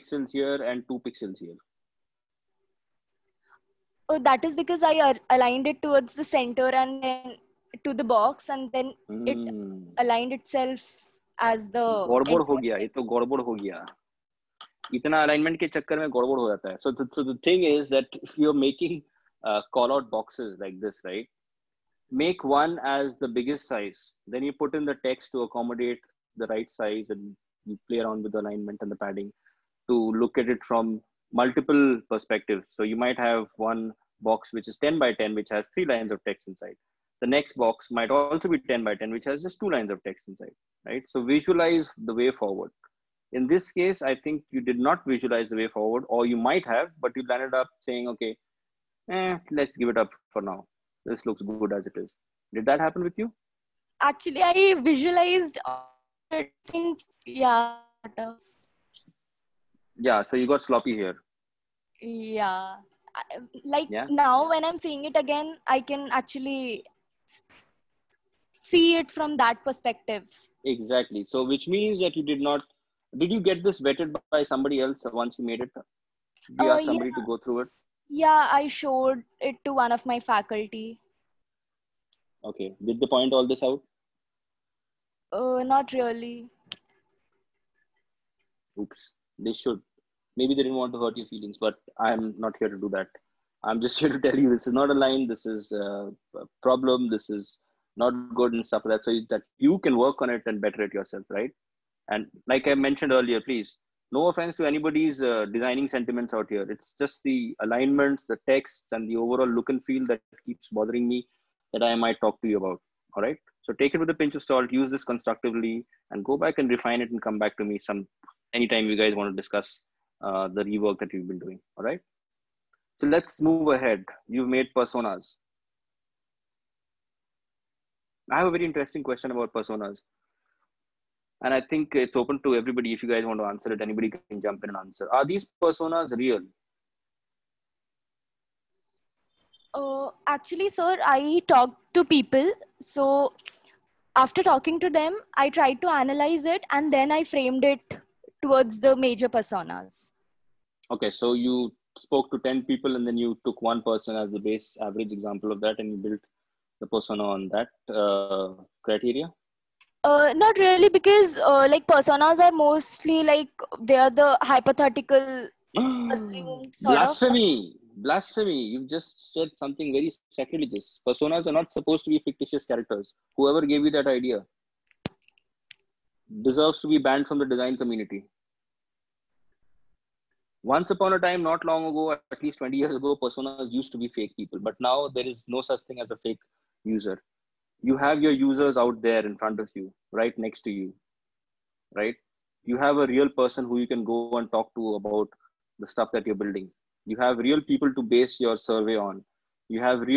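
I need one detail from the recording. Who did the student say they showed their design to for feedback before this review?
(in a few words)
one of my faculty.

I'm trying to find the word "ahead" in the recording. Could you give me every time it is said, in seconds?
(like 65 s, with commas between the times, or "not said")
123 s.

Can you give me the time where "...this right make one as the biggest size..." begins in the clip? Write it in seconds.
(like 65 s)
20 s.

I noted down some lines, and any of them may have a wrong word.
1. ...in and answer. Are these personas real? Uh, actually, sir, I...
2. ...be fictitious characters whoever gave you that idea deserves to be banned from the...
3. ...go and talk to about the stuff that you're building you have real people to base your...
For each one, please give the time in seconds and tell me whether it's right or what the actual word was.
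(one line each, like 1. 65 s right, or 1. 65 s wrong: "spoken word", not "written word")
1. 134 s right
2. 172 s right
3. 194 s right.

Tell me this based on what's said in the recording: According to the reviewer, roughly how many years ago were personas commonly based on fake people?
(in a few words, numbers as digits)
20 years.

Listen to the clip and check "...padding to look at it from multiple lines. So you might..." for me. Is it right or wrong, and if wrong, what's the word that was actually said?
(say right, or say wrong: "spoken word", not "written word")
wrong: "perspectives", not "lines".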